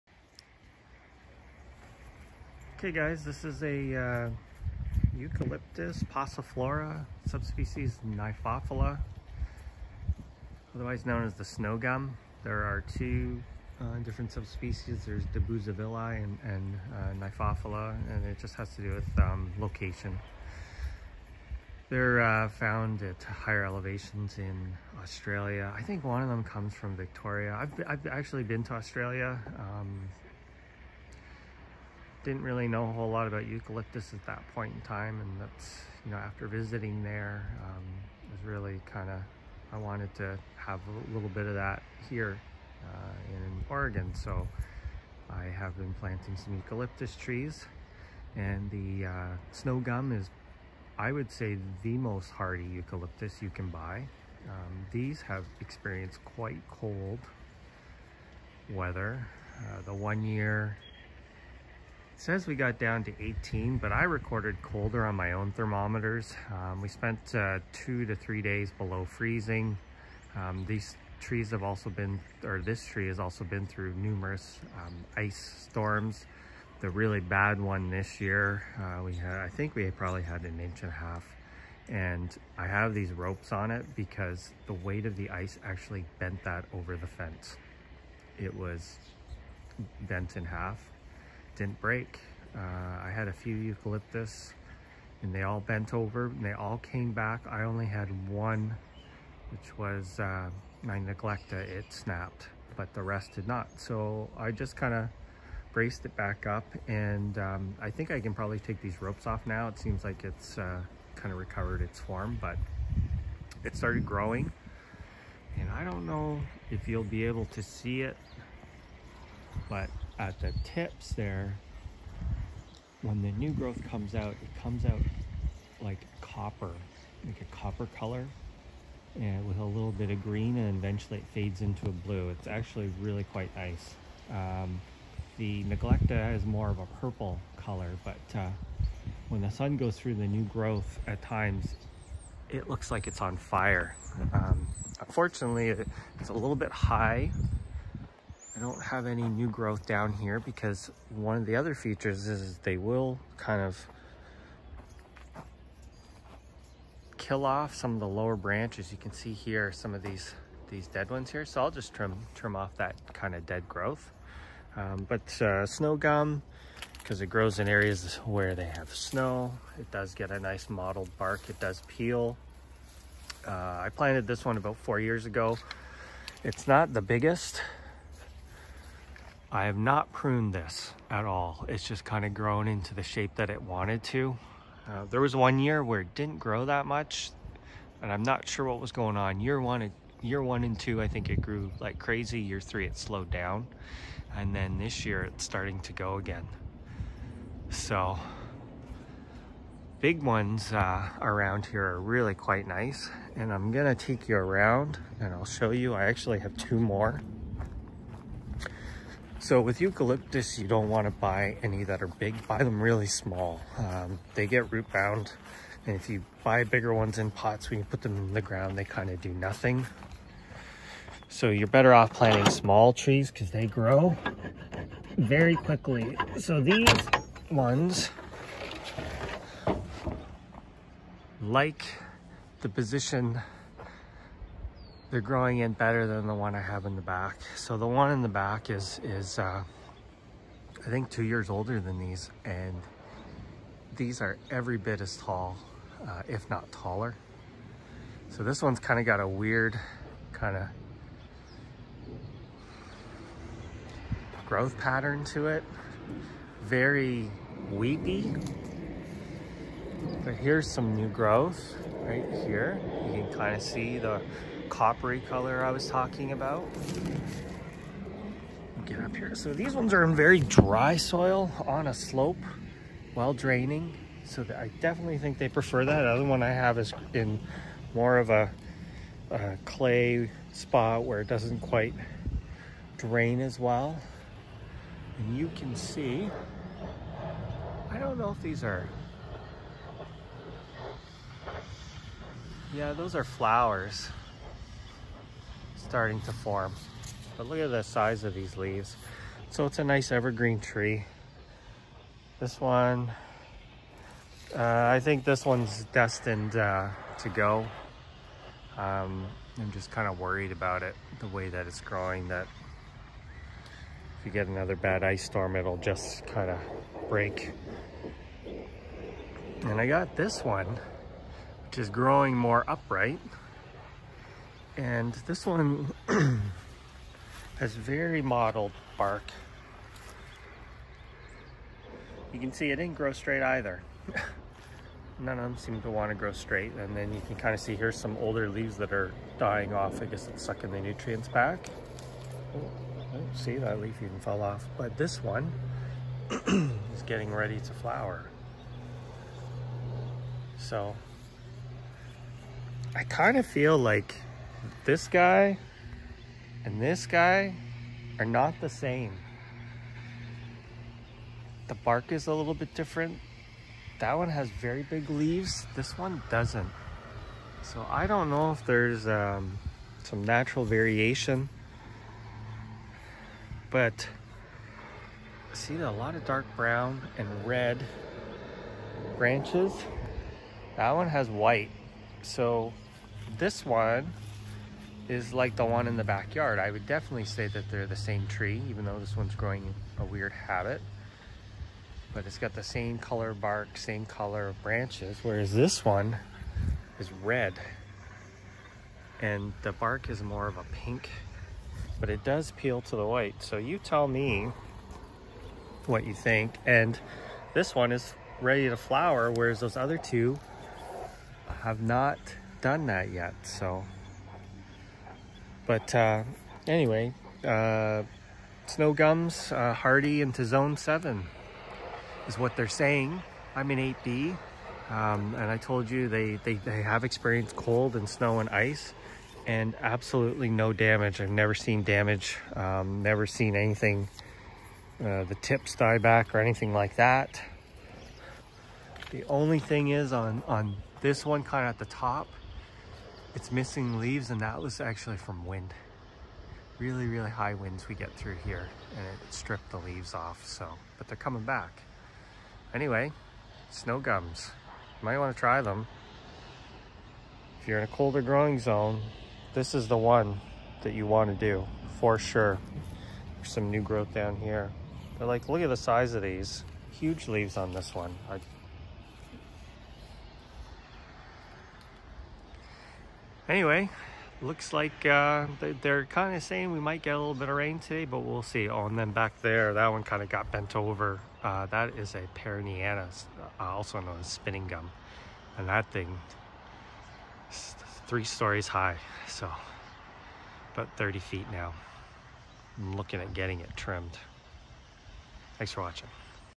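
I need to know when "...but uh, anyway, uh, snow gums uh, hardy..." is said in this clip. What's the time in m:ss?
6:55.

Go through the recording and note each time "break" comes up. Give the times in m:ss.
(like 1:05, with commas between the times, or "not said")
1:31, 5:17.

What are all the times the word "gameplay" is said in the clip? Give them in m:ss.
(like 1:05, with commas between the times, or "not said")
not said.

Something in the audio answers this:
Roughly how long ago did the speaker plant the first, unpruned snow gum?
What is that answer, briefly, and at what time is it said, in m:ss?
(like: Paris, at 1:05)
About four years ago, at 2:54.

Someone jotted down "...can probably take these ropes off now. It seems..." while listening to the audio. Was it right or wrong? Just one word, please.
right.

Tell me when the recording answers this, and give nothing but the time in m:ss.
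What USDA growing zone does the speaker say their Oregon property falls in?
7:03.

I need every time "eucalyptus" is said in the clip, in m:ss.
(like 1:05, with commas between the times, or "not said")
0:05, 0:33, 0:46, 0:52, 1:33, 3:29.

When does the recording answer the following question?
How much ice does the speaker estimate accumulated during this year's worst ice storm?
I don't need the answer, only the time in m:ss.
1:20.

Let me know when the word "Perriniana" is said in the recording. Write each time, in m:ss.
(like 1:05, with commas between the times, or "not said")
8:02.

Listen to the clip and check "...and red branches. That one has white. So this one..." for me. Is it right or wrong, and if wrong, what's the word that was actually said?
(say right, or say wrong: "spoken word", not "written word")
right.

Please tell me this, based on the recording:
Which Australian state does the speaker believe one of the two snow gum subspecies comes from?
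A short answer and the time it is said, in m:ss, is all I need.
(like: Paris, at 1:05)
Victoria, at 0:26.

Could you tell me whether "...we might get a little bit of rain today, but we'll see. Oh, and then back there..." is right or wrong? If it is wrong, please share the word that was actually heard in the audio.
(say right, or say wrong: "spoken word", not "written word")
right.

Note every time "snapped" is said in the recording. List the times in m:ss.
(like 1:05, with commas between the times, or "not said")
1:41.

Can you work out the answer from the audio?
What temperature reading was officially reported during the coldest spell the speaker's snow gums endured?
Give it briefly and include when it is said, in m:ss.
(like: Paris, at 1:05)
18, at 1:03.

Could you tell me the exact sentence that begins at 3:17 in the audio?
So big ones uh, around here are really quite nice.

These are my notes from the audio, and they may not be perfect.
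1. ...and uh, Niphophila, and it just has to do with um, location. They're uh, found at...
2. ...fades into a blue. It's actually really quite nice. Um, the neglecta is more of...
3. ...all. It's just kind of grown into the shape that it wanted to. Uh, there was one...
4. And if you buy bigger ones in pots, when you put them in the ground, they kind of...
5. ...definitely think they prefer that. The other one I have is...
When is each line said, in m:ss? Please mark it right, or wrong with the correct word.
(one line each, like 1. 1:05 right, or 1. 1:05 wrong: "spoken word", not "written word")
1. 0:16 right
2. 2:11 right
3. 3:01 right
4. 3:35 right
5. 4:34 right.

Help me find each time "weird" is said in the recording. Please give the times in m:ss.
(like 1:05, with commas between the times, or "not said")
4:09, 6:30.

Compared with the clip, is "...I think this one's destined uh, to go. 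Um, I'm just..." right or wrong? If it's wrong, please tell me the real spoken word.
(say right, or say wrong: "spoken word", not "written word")
right.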